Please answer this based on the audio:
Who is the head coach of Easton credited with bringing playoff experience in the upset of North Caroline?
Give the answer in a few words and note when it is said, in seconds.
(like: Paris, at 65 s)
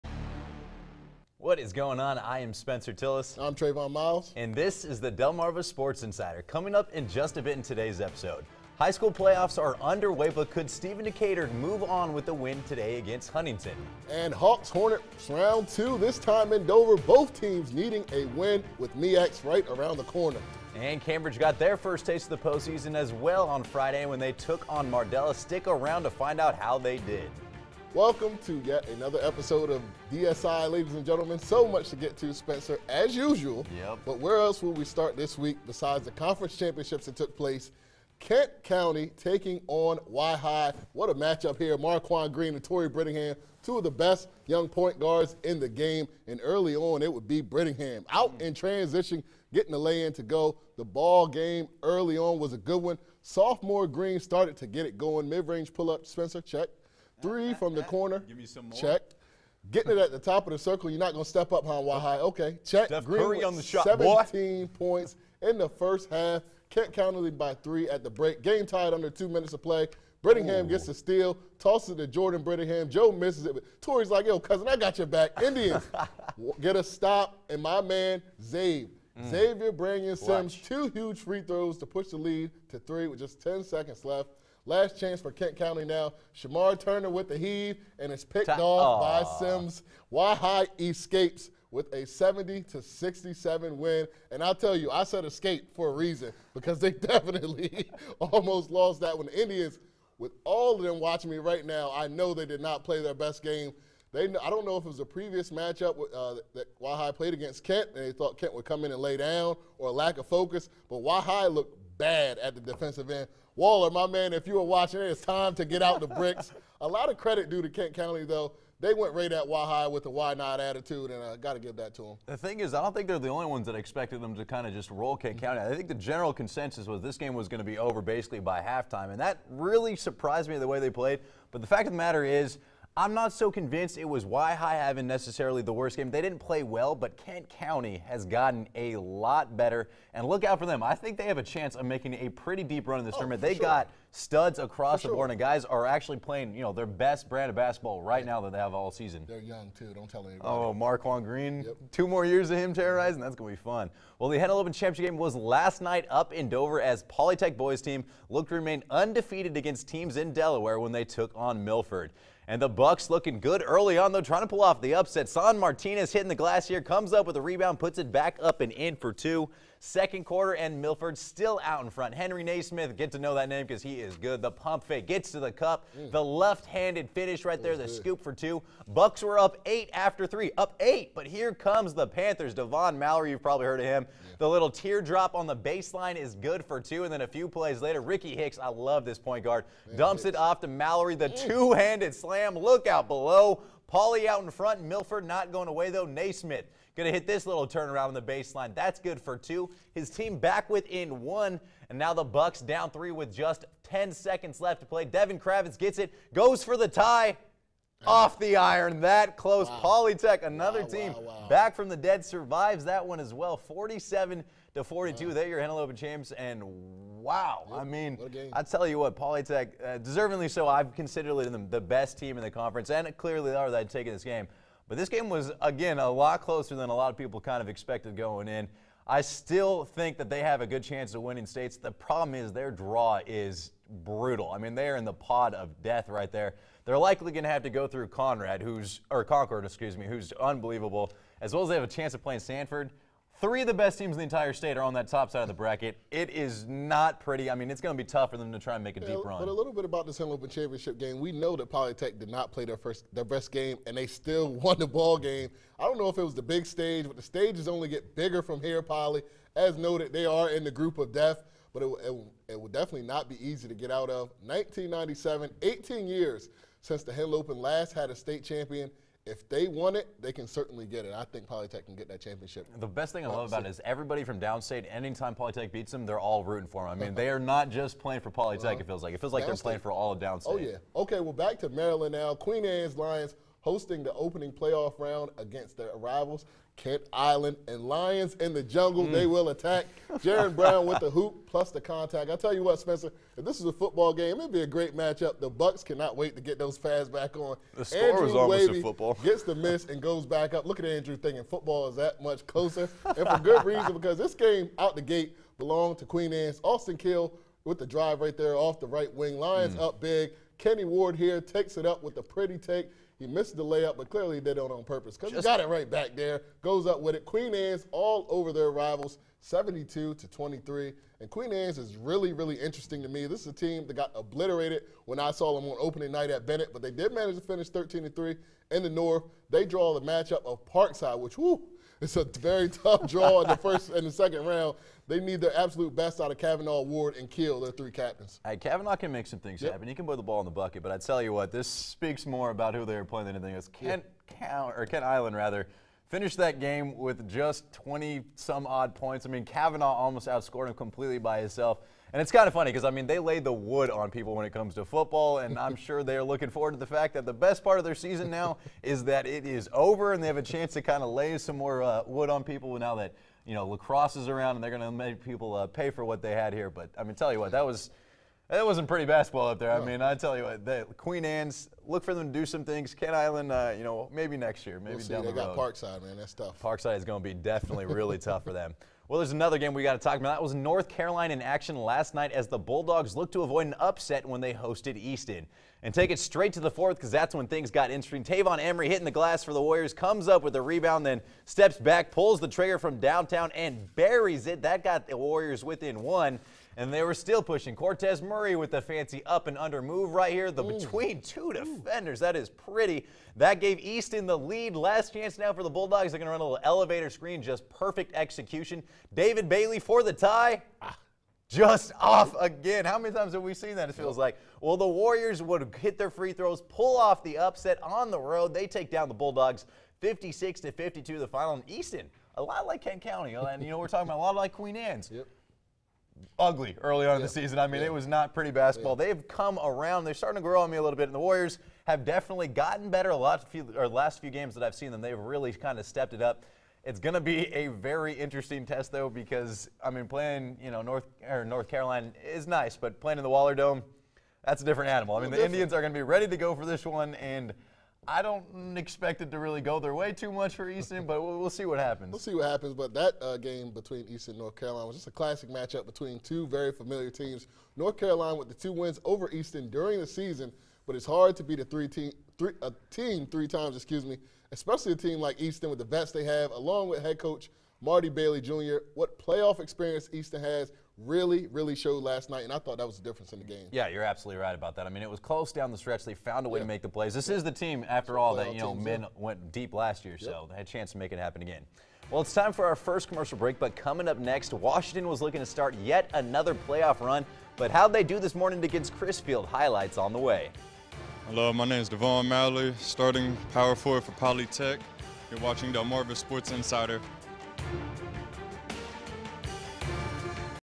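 Marty Bailey Jr., at 467 s.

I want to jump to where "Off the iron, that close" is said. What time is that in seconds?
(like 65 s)
208 s.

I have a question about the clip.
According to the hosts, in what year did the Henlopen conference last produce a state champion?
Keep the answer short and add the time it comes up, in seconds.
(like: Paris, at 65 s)
1997, at 264 s.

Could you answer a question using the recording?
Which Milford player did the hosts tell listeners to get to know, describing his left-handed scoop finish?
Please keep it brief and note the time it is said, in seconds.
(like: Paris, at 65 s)
Henry Naismith, at 172 s.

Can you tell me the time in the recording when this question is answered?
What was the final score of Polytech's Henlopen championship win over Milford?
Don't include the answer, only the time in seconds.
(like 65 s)
213 s.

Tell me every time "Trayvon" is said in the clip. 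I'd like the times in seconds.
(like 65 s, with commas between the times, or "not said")
3 s.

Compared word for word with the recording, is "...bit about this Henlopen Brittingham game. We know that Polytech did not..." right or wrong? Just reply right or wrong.
wrong.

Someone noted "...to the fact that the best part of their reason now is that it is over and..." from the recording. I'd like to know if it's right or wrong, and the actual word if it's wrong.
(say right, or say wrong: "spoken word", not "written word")
wrong: "season", not "reason".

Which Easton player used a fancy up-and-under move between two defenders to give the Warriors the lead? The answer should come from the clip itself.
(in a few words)
Cortez Murray.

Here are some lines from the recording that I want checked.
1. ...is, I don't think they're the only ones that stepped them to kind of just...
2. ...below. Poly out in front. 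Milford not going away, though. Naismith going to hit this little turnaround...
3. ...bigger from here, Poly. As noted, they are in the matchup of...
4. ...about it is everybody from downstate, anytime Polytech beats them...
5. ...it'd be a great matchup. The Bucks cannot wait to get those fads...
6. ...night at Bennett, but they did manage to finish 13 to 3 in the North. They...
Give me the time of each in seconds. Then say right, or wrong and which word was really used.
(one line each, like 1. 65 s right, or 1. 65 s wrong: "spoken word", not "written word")
1. 122 s wrong: "expected", not "stepped"
2. 193 s right
3. 258 s wrong: "group", not "matchup"
4. 273 s right
5. 294 s right
6. 326 s right.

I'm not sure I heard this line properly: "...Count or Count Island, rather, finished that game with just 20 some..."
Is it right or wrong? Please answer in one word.
wrong.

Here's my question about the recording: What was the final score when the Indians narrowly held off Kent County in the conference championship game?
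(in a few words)
70 to 67.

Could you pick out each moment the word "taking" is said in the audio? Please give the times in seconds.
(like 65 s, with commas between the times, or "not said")
39 s, 223 s.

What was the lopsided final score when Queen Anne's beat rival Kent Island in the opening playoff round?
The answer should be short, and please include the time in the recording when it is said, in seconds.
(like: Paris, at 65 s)
72 to 23, at 319 s.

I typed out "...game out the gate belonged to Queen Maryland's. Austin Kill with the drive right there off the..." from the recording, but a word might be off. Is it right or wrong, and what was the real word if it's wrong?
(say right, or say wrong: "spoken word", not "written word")
wrong: "Anne", not "Maryland".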